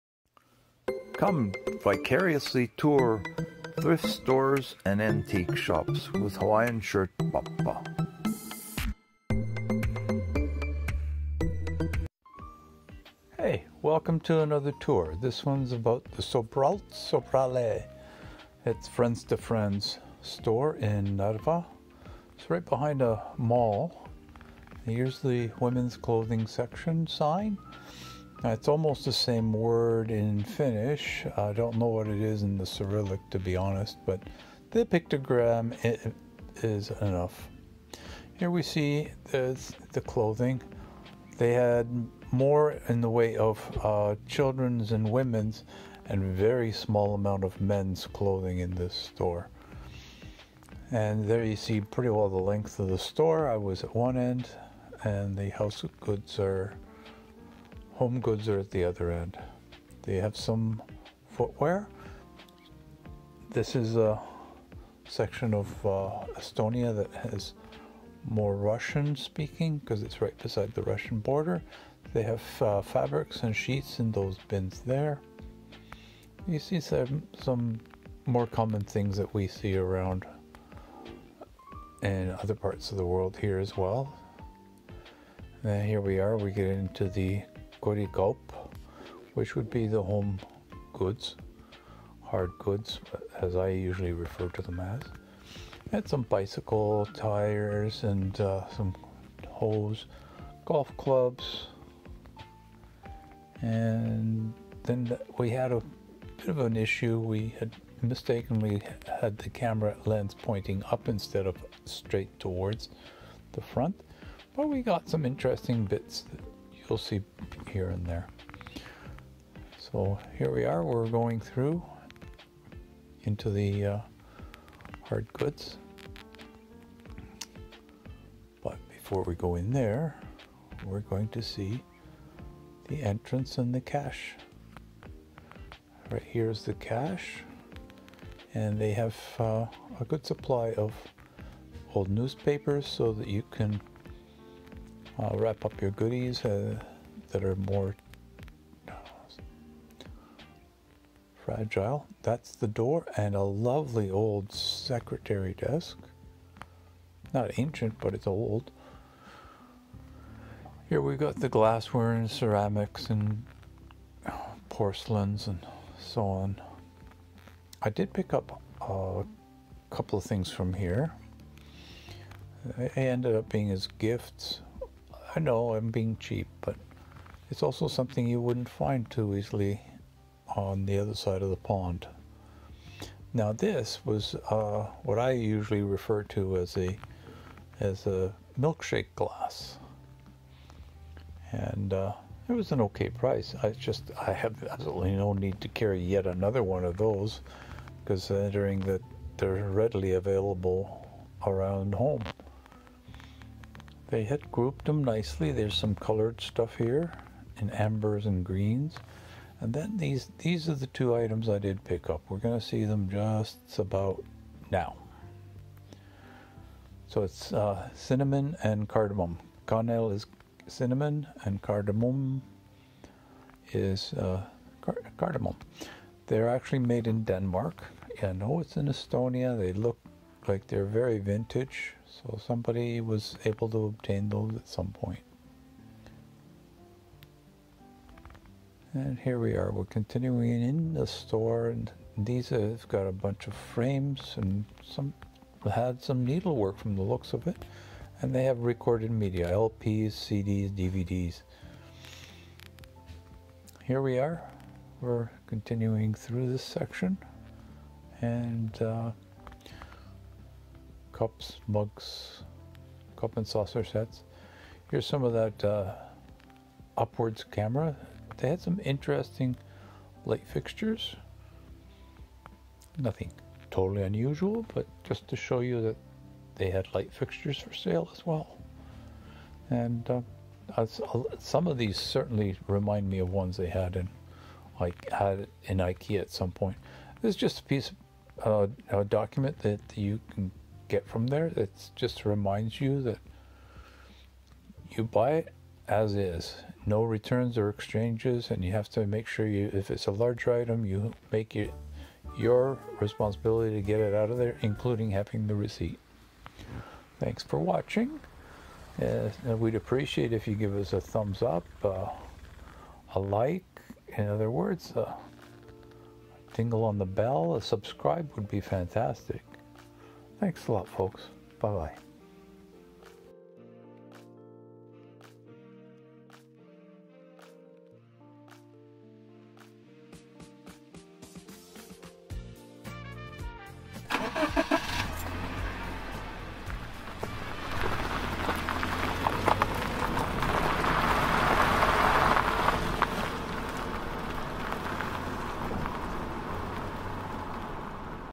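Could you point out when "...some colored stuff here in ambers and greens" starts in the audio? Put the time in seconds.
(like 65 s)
205 s.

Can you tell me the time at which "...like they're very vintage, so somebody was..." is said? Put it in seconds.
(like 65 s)
230 s.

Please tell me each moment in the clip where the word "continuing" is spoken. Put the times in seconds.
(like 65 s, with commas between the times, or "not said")
239 s, 255 s.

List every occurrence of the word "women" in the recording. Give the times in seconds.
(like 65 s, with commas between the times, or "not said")
25 s, 45 s.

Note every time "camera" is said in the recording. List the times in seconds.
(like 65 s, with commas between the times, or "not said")
109 s, 267 s.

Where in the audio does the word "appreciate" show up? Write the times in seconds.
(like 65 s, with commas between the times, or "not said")
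309 s.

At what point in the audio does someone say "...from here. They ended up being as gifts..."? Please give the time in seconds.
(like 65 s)
170 s.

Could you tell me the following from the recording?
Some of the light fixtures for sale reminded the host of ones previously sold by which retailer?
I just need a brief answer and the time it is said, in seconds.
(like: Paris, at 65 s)
IKEA, at 285 s.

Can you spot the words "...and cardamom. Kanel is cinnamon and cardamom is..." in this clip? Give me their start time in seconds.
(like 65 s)
218 s.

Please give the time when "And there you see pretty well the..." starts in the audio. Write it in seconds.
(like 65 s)
50 s.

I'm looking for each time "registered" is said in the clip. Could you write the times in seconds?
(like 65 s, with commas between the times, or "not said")
not said.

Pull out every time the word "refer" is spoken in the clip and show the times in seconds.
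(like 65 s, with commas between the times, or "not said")
94 s, 185 s.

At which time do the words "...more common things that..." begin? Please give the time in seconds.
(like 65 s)
78 s.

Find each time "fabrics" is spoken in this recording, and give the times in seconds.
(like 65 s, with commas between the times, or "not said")
72 s.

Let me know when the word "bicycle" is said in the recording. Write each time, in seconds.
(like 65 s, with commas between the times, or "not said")
96 s.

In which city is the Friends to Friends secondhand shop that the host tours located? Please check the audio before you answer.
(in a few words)
Narva.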